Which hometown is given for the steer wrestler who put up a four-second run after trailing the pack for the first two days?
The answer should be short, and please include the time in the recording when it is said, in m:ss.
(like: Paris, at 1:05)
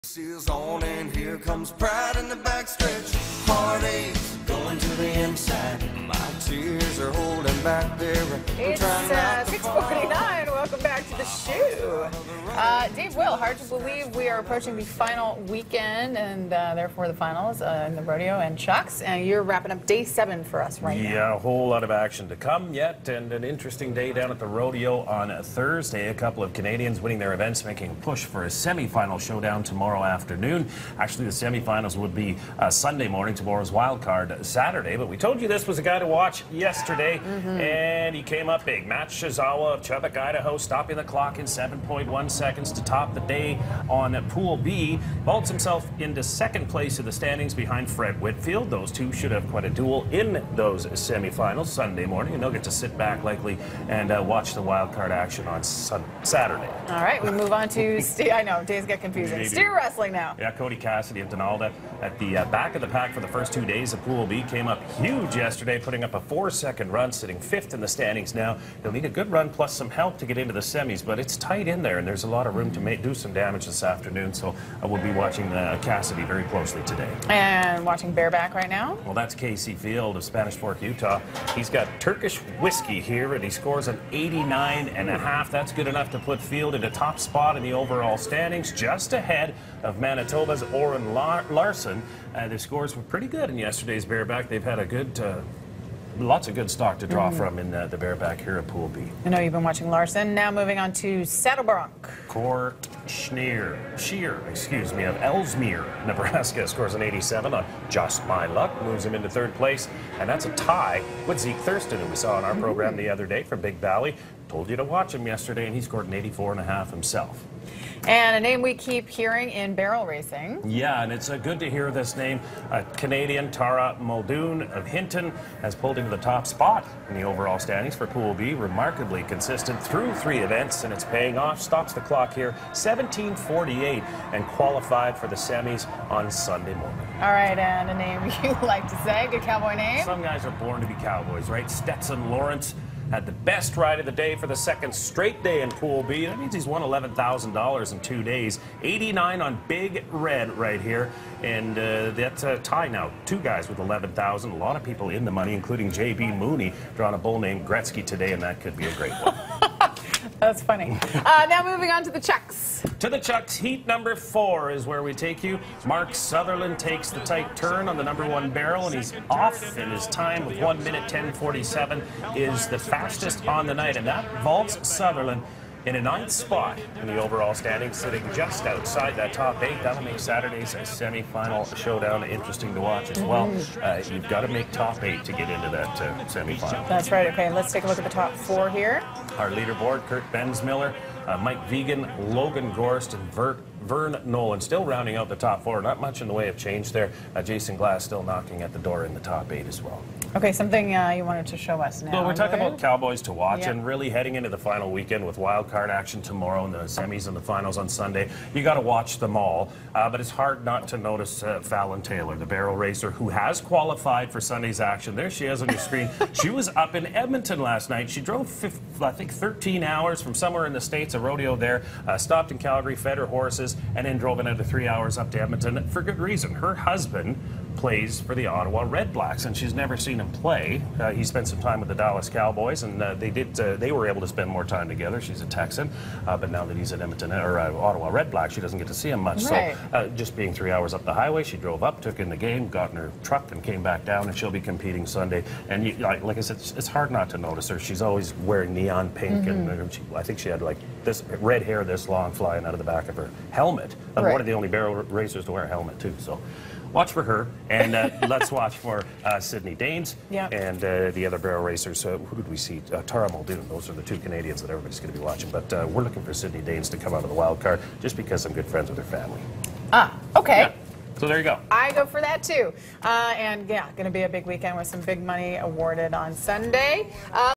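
Donalda, at 1:01.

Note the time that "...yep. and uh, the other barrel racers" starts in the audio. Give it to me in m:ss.
4:20.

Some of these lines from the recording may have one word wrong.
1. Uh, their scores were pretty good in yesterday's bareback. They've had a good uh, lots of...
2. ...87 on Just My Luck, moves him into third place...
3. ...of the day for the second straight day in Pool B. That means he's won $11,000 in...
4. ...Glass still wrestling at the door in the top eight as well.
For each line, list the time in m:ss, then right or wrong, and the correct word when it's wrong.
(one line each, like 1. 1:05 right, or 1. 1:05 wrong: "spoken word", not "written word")
1. 1:32 right
2. 1:47 right
3. 2:23 right
4. 3:17 wrong: "knocking", not "wrestling".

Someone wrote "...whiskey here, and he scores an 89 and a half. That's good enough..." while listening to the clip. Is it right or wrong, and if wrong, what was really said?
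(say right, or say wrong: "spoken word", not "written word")
right.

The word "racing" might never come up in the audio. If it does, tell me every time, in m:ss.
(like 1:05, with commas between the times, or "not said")
2:00.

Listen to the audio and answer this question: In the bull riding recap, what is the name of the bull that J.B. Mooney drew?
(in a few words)
Gretzky.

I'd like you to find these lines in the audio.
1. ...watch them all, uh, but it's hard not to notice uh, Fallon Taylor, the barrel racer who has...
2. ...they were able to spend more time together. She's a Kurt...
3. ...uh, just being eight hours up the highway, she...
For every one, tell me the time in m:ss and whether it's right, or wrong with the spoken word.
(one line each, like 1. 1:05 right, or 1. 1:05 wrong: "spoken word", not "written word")
1. 3:28 right
2. 3:53 wrong: "Texan", not "Kurt"
3. 3:59 wrong: "three", not "eight".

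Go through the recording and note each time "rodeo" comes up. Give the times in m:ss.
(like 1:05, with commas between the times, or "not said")
0:18, 0:24, 3:41.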